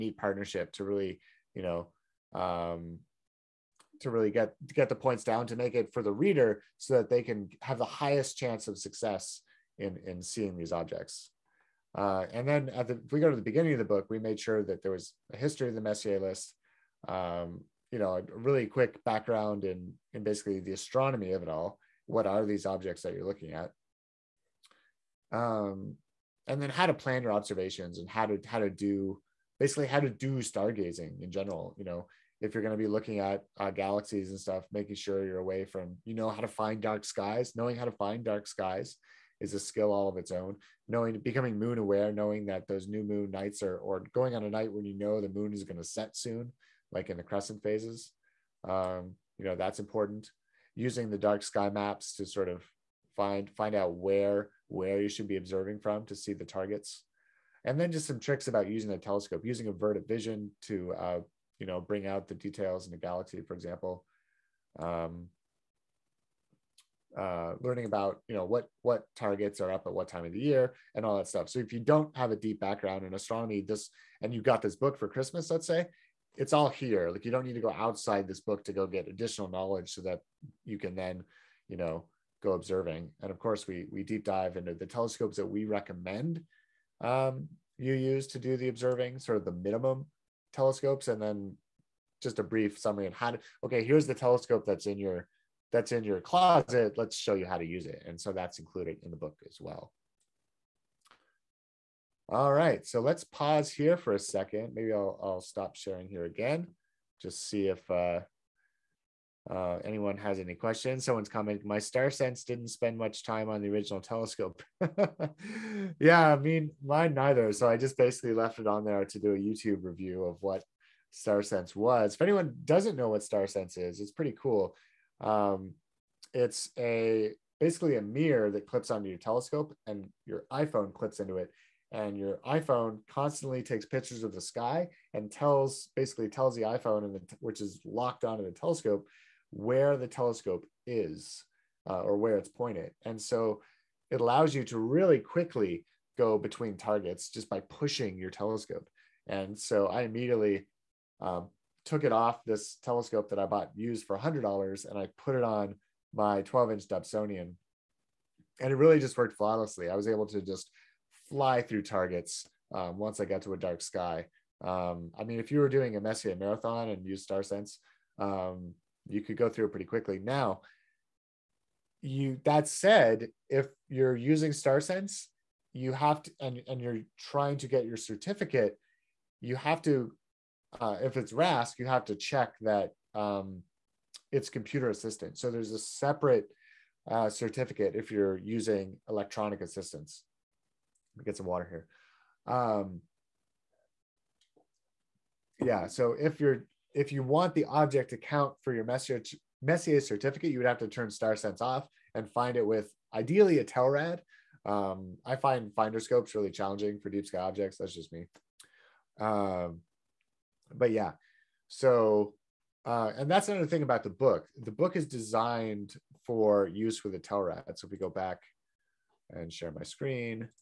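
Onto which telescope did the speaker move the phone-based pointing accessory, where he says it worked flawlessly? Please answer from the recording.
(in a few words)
12 inch Dobsonian.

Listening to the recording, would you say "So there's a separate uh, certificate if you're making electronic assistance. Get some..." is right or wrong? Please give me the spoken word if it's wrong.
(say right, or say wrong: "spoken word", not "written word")
wrong: "using", not "making".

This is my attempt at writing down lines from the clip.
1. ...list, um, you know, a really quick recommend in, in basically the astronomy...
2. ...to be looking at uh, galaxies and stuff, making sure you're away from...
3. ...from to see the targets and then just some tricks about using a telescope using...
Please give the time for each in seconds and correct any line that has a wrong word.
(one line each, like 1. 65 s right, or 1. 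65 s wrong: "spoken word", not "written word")
1. 16 s wrong: "background", not "recommend"
2. 32 s right
3. 55 s right.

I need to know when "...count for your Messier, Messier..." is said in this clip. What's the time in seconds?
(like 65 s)
198 s.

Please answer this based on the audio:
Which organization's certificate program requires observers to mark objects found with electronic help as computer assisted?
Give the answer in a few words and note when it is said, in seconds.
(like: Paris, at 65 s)
RASC, at 181 s.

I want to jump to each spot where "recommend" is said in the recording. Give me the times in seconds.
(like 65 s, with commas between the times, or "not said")
85 s.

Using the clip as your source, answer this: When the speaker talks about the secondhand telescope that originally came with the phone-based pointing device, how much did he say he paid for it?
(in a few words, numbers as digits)
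$100.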